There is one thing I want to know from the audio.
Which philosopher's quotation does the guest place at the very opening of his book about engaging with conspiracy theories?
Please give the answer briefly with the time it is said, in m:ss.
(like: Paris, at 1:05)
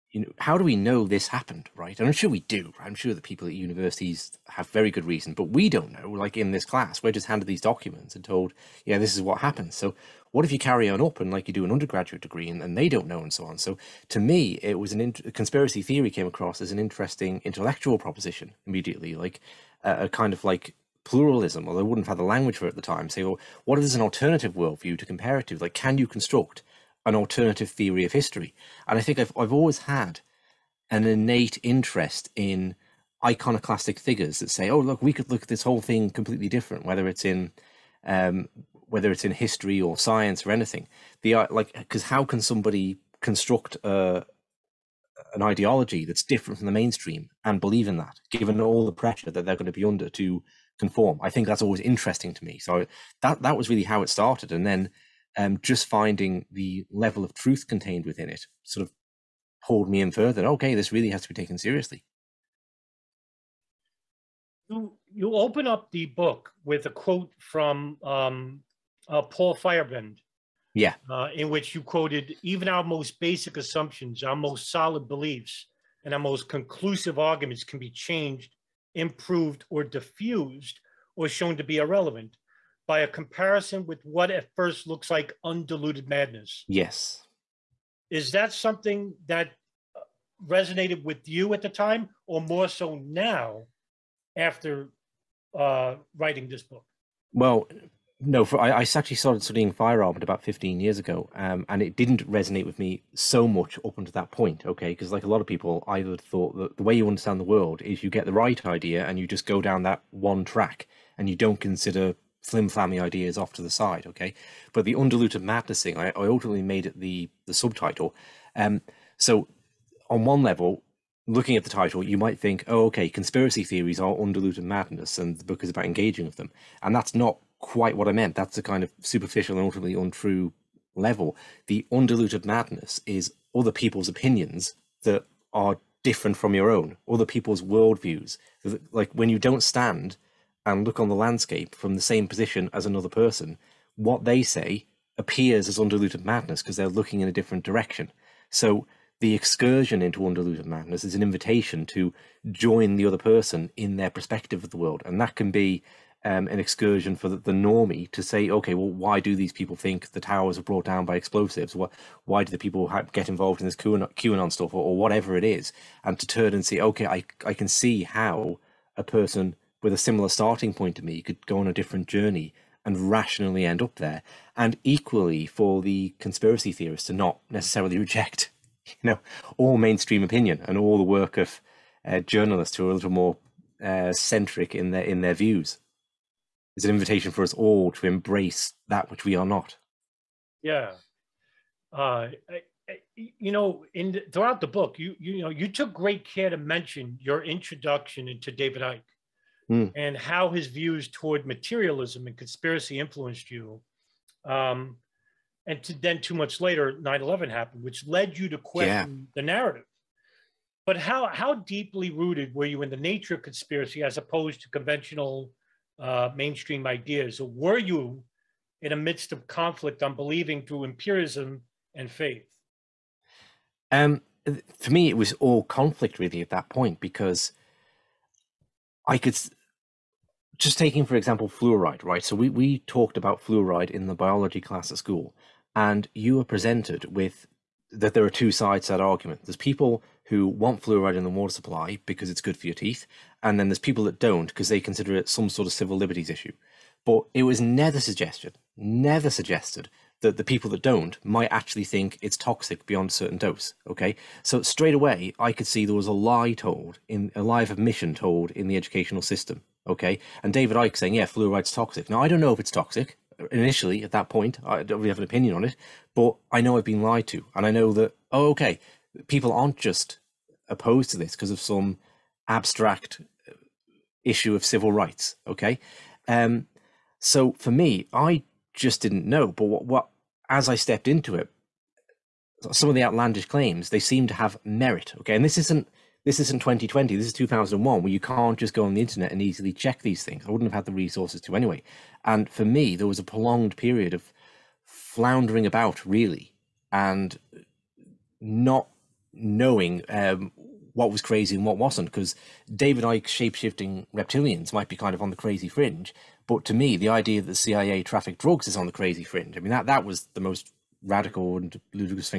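Paul Feyerabend, at 1:09.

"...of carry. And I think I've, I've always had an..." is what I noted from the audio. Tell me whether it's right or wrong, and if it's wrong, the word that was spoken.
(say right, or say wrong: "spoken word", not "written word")
wrong: "history", not "carry".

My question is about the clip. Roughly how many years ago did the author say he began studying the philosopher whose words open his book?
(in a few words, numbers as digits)
15.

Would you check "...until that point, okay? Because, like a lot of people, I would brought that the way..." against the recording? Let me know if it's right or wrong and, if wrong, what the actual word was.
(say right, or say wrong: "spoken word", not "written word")
wrong: "thought", not "brought".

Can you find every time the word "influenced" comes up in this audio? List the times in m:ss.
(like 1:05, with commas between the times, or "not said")
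3:22.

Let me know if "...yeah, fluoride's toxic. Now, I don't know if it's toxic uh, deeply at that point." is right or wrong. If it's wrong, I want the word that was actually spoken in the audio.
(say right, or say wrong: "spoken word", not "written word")
wrong: "initially", not "deeply".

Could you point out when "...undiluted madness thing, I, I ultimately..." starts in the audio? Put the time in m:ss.
1:54.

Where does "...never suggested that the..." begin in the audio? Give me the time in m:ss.
4:08.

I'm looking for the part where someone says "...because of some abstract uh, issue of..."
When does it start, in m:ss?
4:31.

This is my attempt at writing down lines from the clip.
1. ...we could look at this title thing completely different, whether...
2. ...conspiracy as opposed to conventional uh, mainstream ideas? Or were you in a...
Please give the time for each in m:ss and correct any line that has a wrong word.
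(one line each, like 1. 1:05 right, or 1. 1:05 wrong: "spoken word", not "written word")
1. 0:35 wrong: "whole", not "title"
2. 3:33 right.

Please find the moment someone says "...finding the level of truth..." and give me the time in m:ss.
0:55.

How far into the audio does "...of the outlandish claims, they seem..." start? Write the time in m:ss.
4:42.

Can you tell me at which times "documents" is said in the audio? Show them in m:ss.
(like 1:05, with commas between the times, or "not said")
0:07.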